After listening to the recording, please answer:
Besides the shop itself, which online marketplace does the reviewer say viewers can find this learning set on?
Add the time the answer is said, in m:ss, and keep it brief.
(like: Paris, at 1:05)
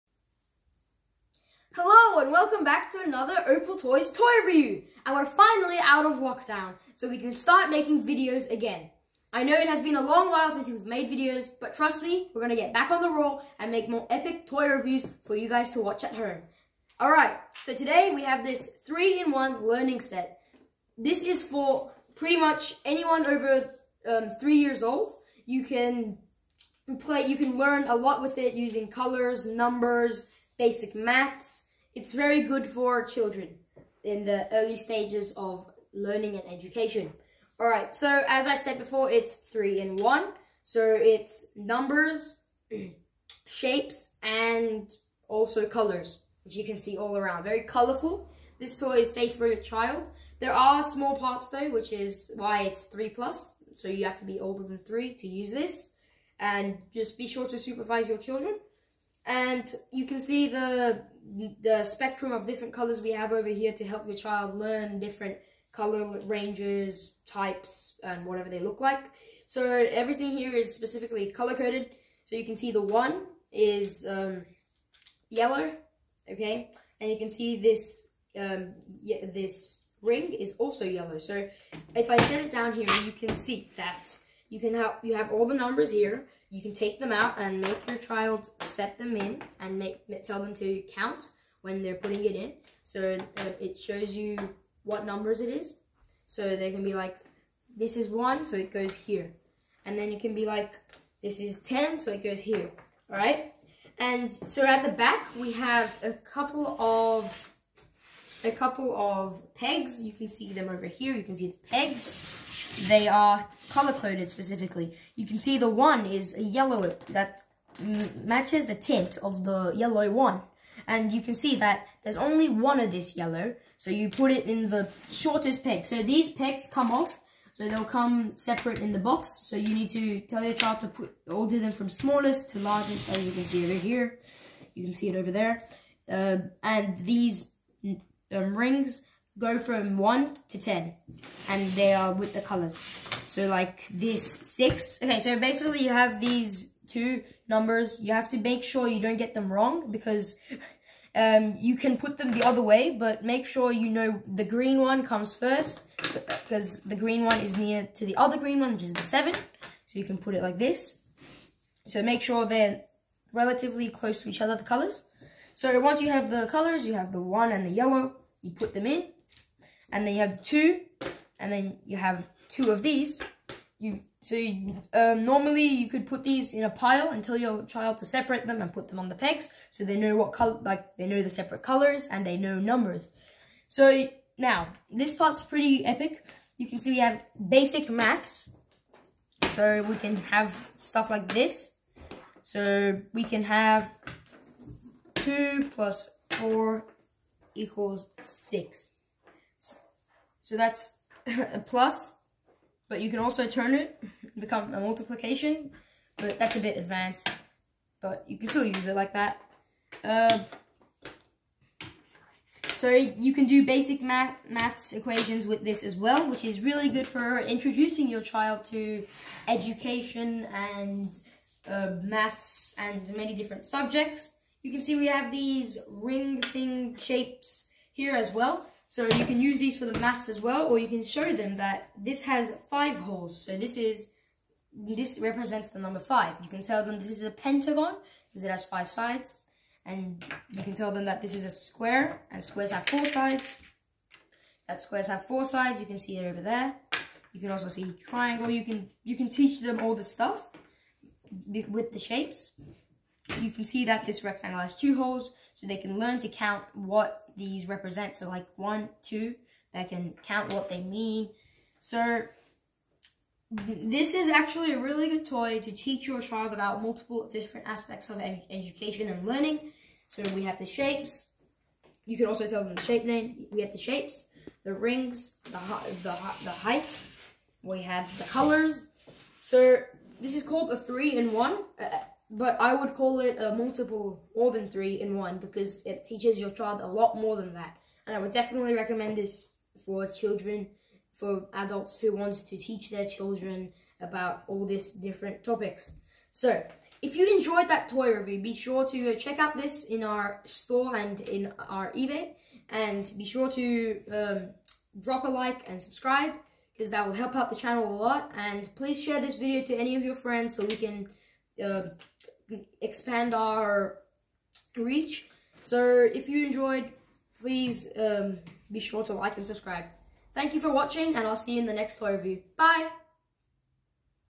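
eBay, at 5:01.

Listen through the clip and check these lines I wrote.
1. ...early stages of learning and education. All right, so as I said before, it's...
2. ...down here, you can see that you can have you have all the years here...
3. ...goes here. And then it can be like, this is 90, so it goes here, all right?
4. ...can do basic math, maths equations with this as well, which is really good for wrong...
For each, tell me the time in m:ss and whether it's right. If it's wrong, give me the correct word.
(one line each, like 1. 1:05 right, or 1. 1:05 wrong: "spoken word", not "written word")
1. 0:34 right
2. 1:22 wrong: "numbers", not "years"
3. 1:38 wrong: "10", not "90"
4. 3:33 wrong: "introducing", not "wrong".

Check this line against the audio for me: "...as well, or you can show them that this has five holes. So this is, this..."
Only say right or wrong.
right.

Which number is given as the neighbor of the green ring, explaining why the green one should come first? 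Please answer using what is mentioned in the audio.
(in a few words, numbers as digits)
7.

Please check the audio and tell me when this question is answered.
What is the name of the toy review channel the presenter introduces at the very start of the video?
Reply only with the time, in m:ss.
0:03.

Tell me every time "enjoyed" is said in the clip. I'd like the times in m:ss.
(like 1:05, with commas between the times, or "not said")
4:57, 5:16.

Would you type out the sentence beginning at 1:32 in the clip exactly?
So uh, it shows you what numbers it is.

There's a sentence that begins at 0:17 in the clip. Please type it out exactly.
Alright, so today we have this 3-in-1 learning set.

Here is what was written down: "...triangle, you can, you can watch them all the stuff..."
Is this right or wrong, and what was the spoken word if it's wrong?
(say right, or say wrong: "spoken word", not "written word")
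wrong: "teach", not "watch".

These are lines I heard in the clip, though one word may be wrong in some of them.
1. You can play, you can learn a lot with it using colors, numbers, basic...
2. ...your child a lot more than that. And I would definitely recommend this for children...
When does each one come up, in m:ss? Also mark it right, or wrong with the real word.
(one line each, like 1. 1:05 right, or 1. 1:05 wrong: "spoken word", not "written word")
1. 0:25 right
2. 4:46 right.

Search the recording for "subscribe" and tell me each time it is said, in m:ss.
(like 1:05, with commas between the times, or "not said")
5:05, 5:19.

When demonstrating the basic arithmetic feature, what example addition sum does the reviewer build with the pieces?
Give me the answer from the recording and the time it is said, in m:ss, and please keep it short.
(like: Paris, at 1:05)
2 plus 4 equals 6, at 3:15.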